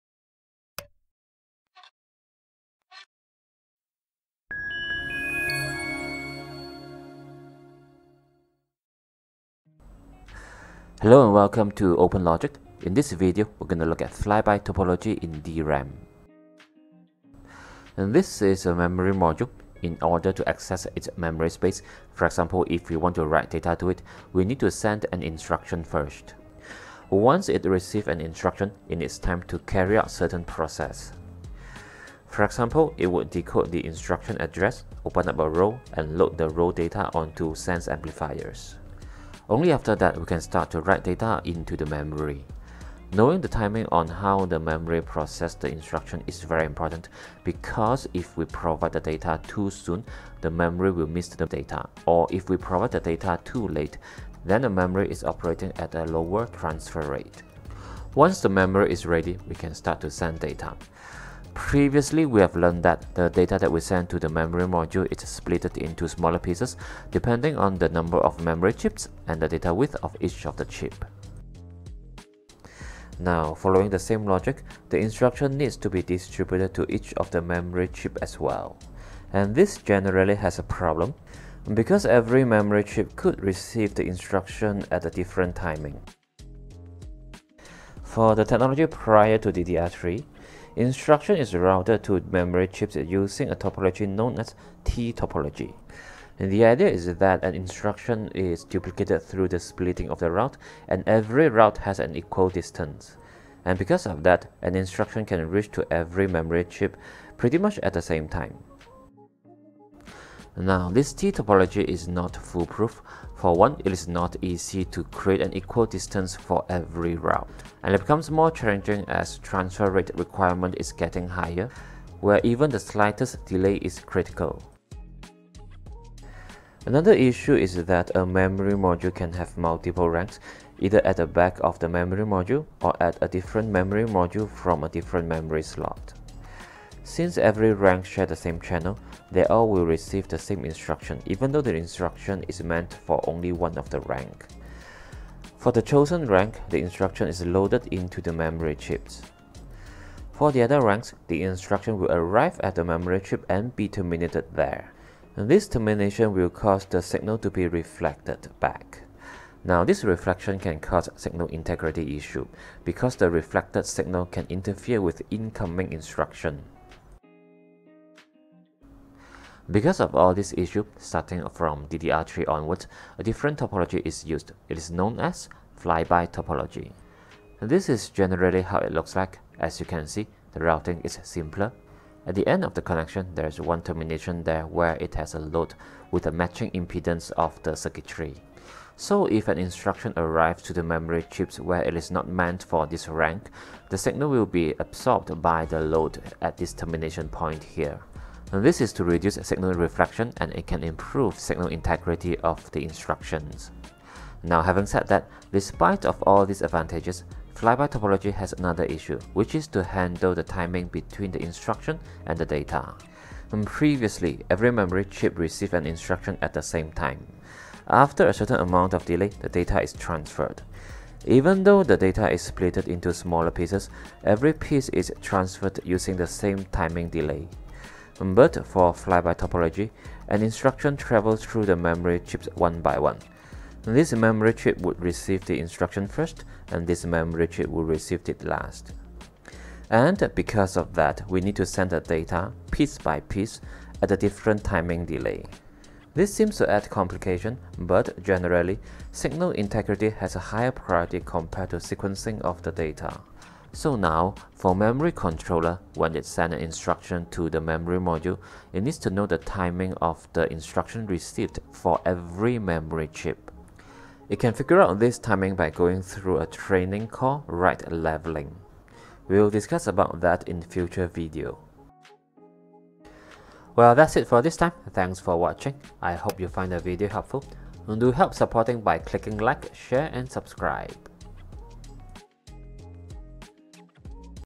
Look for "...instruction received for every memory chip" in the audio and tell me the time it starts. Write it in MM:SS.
04:20.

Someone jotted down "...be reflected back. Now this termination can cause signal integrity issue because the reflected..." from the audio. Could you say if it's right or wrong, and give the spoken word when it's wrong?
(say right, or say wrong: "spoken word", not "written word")
wrong: "reflection", not "termination".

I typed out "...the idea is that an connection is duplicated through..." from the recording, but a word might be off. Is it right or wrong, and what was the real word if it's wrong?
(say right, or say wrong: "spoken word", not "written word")
wrong: "instruction", not "connection".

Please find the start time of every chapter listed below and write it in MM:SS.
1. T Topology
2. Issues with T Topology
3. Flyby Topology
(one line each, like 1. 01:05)
1. 01:27
2. 01:50
3. 02:48.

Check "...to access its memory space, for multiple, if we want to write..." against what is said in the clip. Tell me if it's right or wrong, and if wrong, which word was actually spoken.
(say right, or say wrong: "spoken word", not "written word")
wrong: "example", not "multiple".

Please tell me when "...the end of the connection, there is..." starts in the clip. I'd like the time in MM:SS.
03:02.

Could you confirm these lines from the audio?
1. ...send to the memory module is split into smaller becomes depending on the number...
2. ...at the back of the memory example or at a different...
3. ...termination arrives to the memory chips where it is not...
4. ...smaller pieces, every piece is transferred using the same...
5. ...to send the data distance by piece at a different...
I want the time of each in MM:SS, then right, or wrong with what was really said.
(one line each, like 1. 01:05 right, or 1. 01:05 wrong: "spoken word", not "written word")
1. 01:03 wrong: "pieces", not "becomes"
2. 02:11 wrong: "module", not "example"
3. 03:09 wrong: "instruction", not "termination"
4. 03:43 right
5. 04:01 wrong: "piece", not "distance".